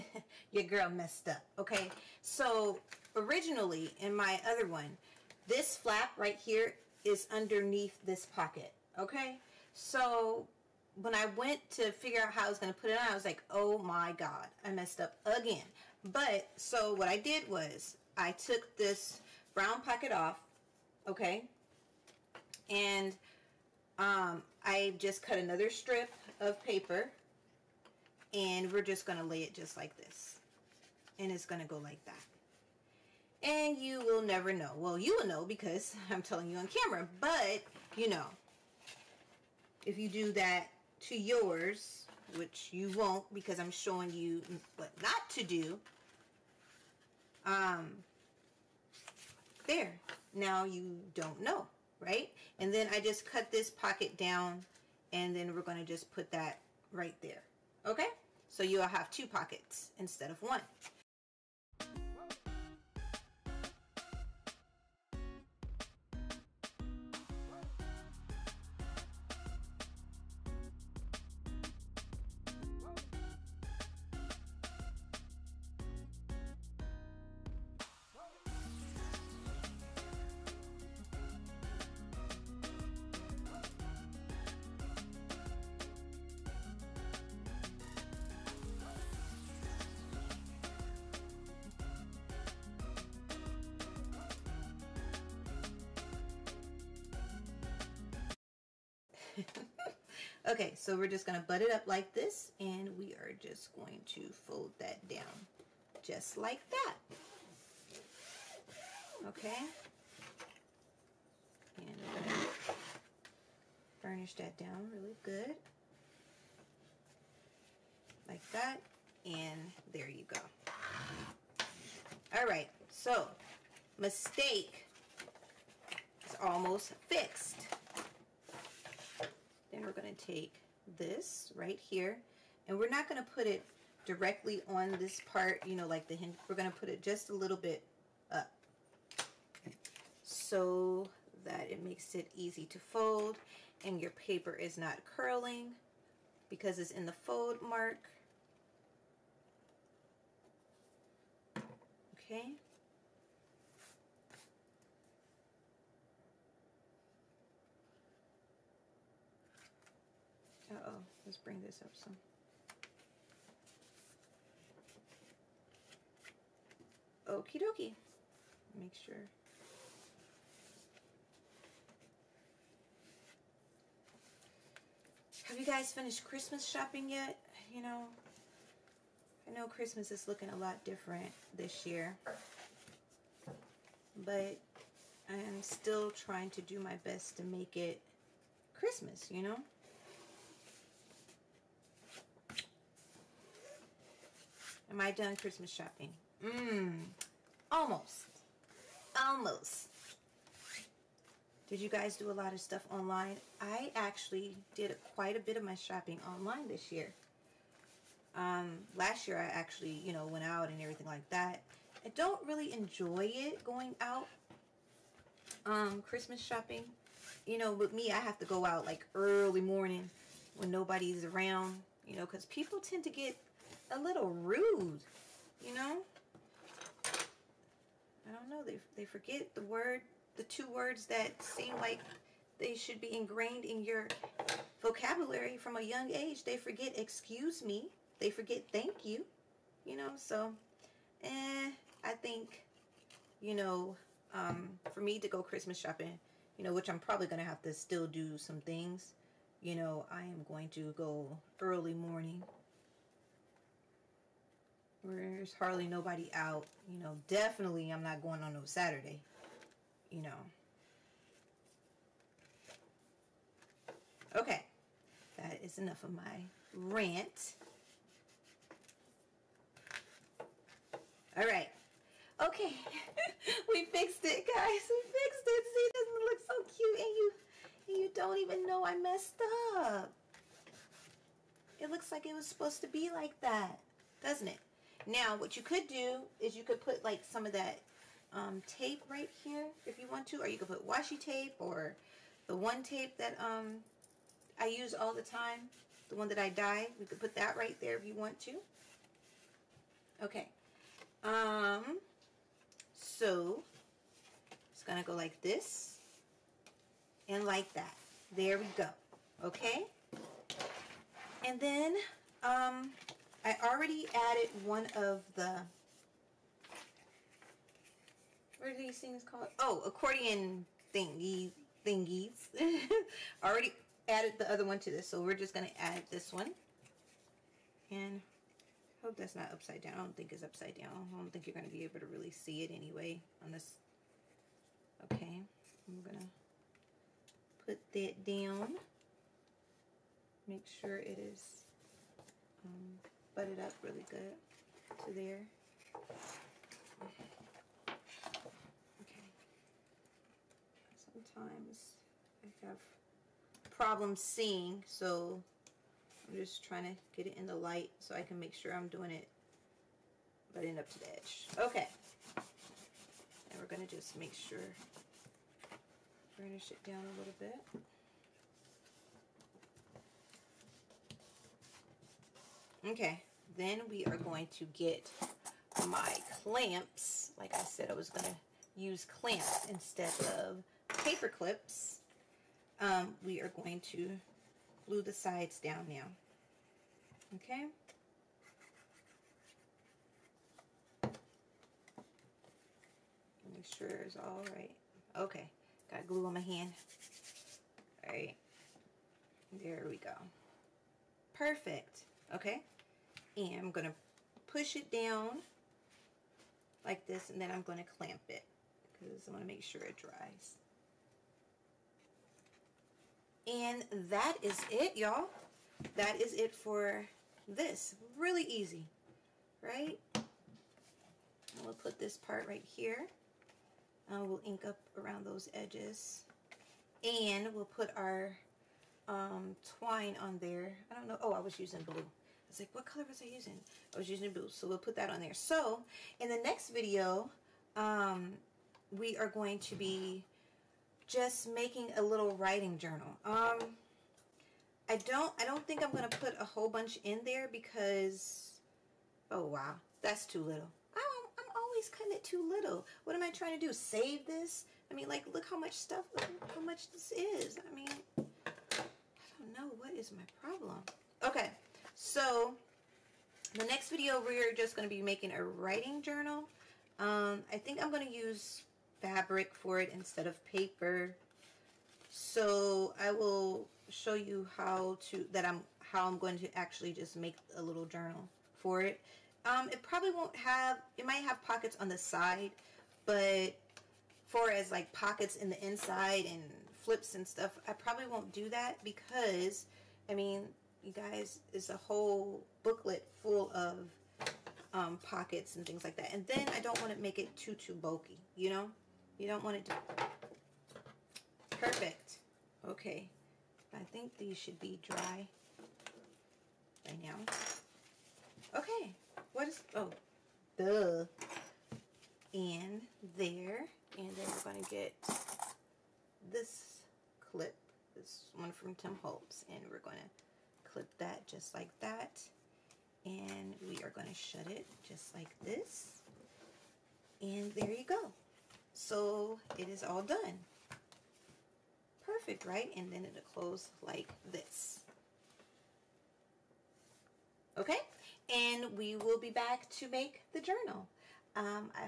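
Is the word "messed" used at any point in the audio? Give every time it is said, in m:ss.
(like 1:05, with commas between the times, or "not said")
0:00, 0:14, 4:38.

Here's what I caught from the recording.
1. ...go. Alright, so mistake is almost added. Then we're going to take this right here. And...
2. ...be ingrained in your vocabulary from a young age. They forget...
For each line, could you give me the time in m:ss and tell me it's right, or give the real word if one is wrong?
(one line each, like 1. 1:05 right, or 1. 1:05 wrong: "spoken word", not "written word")
1. 2:00 wrong: "fixed", not "added"
2. 3:52 right.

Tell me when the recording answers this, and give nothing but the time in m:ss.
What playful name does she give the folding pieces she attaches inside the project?
5:19.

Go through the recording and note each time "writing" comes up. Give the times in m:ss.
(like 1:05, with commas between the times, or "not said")
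7:22, 7:45.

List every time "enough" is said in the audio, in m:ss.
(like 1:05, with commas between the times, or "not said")
4:25.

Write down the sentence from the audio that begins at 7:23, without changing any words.
Um, I don't, I don't think I'm going to put a whole bunch in there because, oh wow, that's too little.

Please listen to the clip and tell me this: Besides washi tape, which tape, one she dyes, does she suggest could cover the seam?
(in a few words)
The one tape.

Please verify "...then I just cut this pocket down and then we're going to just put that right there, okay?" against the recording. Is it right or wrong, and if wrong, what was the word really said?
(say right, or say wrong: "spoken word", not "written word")
right.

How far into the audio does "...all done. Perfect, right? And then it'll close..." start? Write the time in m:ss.
8:49.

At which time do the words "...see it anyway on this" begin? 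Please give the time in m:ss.
5:32.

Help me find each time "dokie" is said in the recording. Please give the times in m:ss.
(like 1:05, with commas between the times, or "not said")
2:47.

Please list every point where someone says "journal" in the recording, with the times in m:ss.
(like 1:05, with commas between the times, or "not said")
7:22, 7:46, 7:57, 9:00.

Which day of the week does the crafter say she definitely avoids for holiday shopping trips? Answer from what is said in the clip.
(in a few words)
Saturday.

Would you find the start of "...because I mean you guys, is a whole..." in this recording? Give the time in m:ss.
8:08.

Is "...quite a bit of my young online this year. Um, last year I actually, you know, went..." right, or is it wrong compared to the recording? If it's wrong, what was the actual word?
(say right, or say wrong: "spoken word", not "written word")
wrong: "shopping", not "young".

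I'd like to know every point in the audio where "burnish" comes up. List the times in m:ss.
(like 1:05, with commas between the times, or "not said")
1:54, 6:06.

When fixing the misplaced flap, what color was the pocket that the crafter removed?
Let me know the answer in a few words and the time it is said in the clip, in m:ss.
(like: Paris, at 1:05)
Brown, at 0:19.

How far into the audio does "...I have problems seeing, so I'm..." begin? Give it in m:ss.
5:52.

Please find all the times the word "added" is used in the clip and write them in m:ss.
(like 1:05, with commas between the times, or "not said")
5:14, 5:24.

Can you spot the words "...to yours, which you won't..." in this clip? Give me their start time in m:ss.
0:40.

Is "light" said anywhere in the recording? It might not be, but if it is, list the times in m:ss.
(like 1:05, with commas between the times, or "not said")
5:57.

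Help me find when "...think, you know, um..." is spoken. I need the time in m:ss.
4:02.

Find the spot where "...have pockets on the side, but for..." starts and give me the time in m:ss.
8:01.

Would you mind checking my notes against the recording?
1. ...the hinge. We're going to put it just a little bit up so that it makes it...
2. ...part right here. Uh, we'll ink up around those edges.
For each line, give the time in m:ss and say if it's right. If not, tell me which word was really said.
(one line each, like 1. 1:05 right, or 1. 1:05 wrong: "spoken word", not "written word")
1. 2:16 right
2. 7:02 right.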